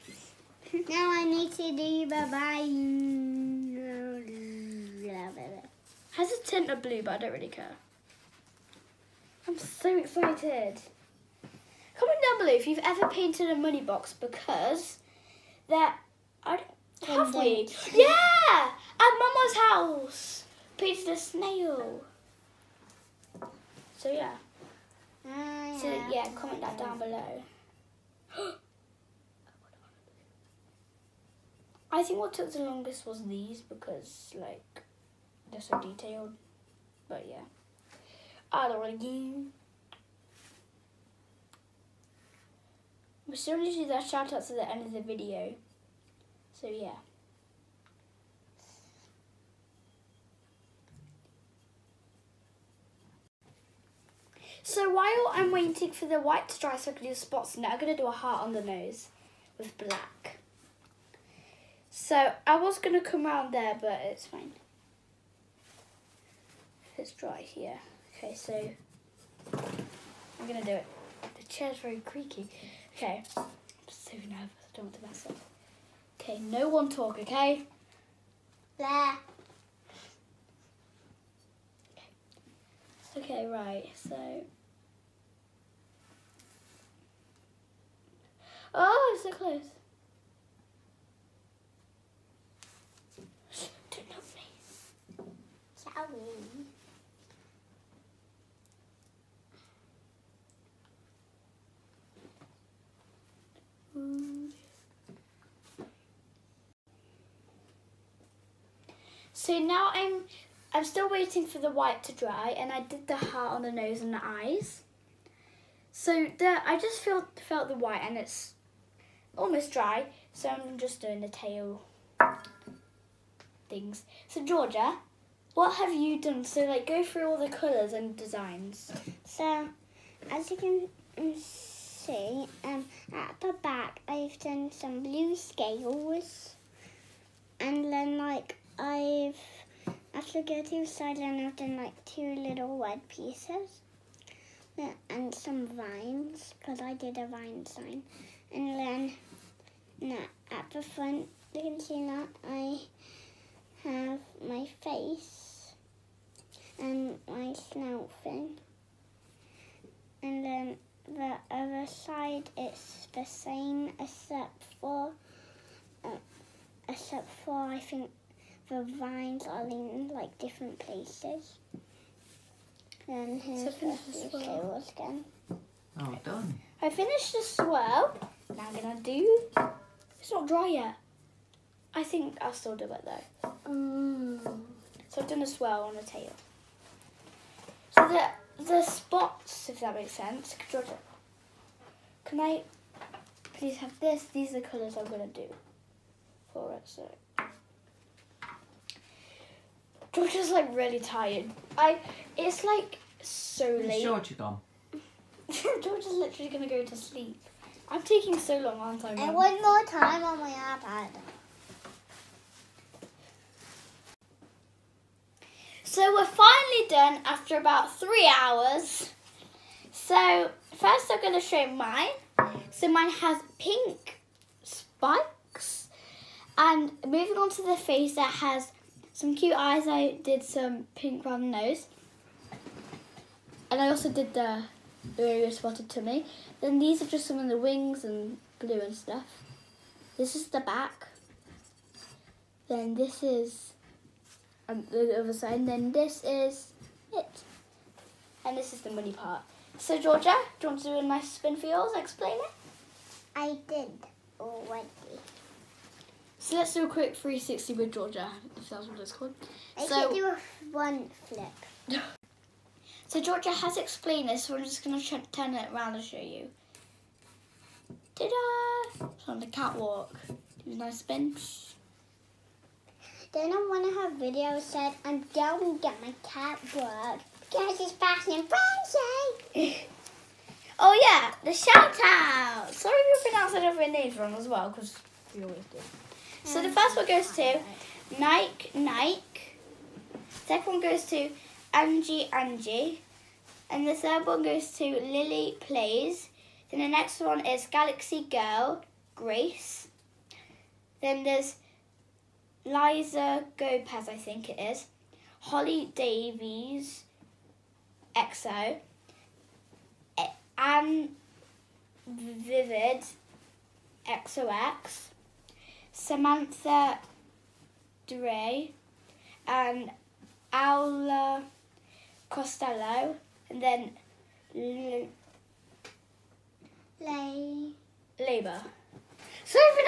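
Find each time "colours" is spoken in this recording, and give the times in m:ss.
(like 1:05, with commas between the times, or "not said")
2:07, 3:14.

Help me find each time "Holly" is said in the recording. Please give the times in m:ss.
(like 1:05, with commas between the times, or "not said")
5:05.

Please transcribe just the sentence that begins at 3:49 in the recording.
I did some pink round nose.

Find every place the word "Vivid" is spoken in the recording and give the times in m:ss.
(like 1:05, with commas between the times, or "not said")
5:12.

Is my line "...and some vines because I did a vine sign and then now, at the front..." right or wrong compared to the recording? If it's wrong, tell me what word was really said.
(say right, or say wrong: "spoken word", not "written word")
right.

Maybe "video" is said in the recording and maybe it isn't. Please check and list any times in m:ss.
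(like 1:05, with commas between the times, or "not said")
0:45, 4:34.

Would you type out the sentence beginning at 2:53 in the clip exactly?
And here's so the swirl again.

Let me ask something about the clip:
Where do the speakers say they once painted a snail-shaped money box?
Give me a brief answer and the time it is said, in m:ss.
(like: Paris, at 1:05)
At Mama's house, at 0:18.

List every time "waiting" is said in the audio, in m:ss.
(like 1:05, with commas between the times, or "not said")
0:55, 1:51.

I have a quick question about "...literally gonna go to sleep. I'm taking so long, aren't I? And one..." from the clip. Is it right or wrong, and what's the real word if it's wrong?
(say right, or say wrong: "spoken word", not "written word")
right.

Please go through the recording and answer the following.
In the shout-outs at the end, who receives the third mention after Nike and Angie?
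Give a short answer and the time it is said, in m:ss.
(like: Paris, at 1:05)
Lily Plays, at 4:54.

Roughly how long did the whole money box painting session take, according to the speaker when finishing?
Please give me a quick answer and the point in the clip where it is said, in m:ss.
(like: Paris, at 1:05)
About 3 hours, at 3:37.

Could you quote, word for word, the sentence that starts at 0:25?
Mm, so yeah, comment that down below.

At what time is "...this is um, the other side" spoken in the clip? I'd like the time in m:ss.
4:02.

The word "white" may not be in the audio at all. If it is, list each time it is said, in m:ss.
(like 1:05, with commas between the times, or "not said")
0:56, 1:51, 1:57.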